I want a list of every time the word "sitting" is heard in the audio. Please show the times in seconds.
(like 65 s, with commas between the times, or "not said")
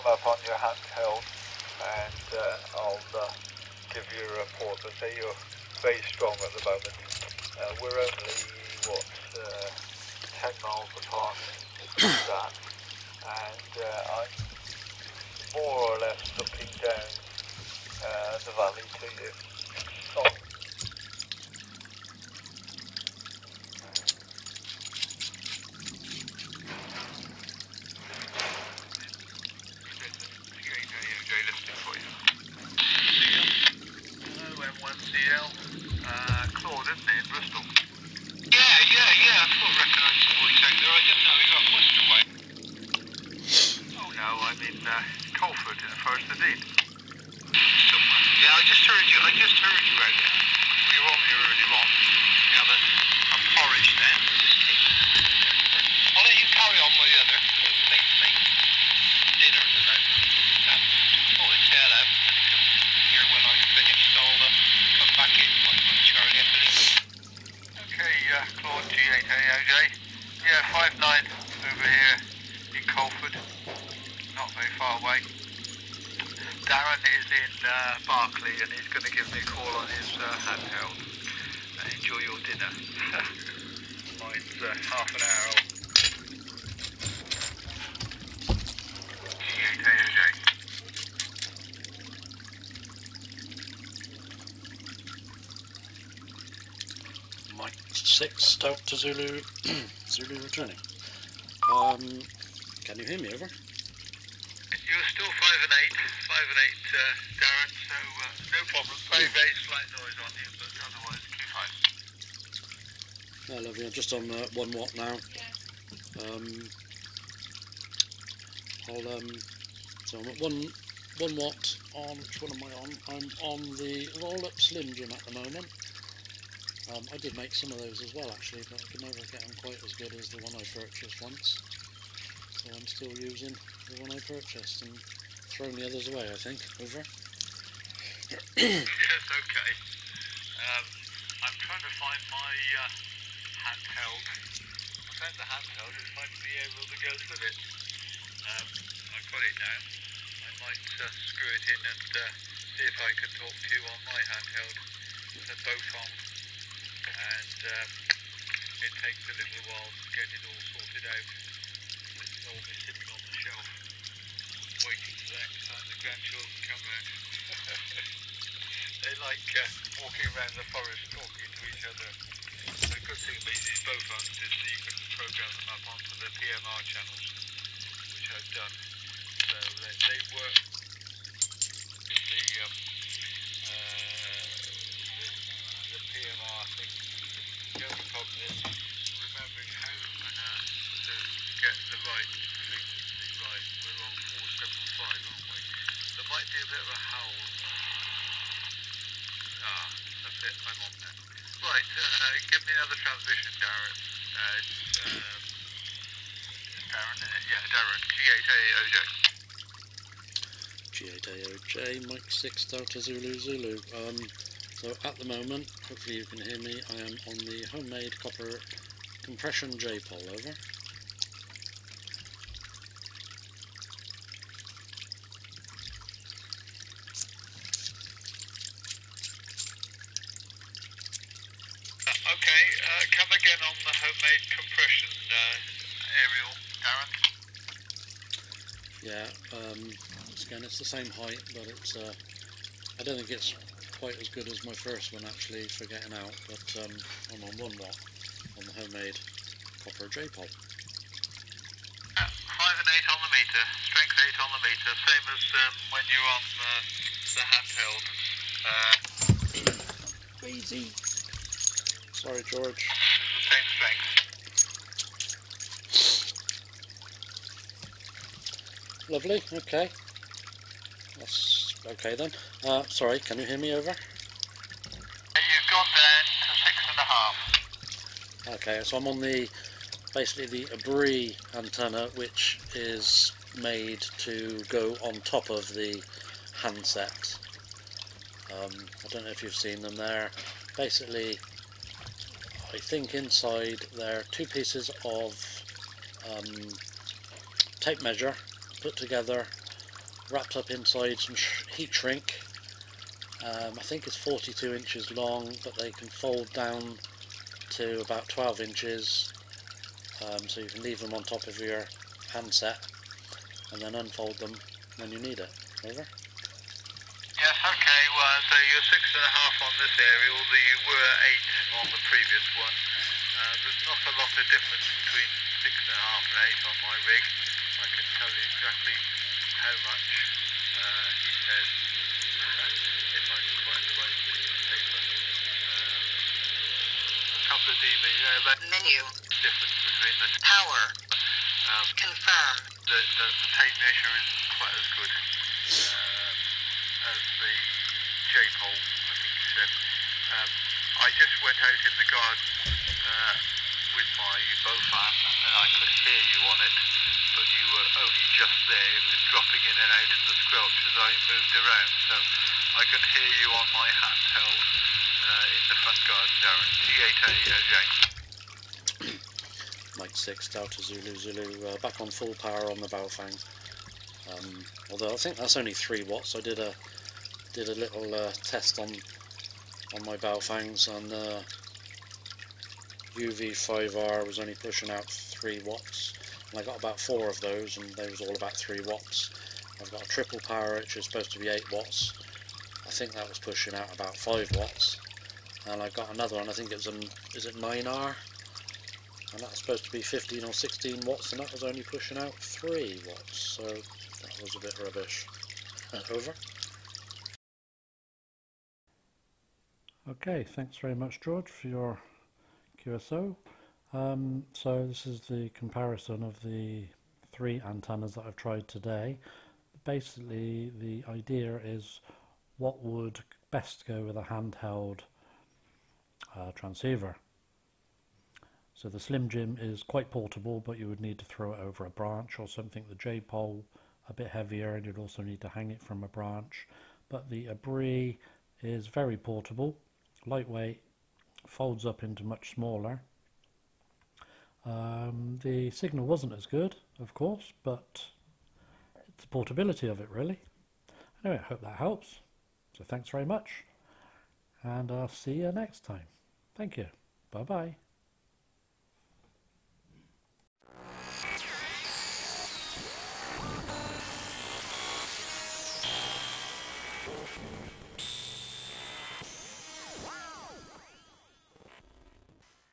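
162 s.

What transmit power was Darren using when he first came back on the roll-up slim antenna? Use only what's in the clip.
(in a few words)
1 watt.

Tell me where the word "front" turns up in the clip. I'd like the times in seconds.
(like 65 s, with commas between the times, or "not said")
365 s.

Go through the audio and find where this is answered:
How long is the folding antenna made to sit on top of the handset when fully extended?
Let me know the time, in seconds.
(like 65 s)
304 s.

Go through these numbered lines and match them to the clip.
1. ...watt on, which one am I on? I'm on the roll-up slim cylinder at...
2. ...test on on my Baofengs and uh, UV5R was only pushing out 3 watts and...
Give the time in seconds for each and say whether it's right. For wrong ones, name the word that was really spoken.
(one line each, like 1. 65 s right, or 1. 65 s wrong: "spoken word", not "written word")
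1. 121 s right
2. 378 s right.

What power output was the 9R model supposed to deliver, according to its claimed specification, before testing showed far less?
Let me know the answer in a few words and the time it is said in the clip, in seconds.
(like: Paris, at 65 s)
15 or 16 watts, at 400 s.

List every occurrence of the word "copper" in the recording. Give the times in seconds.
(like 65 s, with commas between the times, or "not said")
218 s, 249 s.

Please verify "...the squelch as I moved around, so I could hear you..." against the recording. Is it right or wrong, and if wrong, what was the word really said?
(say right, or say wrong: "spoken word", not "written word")
right.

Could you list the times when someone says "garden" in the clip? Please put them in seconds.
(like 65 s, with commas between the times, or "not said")
352 s.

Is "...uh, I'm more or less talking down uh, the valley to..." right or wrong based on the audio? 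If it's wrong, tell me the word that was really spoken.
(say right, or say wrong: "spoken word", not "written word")
wrong: "looking", not "talking".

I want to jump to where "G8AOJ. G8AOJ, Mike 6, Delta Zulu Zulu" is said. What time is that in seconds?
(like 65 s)
212 s.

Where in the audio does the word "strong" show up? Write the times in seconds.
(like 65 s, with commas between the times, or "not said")
6 s.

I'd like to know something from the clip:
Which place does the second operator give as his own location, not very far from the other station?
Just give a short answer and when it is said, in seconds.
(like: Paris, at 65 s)
Coleford, at 72 s.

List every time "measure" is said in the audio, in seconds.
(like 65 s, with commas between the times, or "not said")
298 s, 343 s.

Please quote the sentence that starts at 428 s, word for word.
So the Slim Jim is quite portable but you would need to throw it over a branch or something.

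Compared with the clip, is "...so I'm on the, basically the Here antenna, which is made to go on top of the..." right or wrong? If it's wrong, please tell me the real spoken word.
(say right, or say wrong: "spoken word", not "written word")
wrong: "Abbree", not "Here".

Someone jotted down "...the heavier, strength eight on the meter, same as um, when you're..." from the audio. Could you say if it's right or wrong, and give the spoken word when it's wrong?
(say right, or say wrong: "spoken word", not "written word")
wrong: "meter", not "heavier".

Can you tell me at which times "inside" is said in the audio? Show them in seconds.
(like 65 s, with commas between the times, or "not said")
293 s, 300 s.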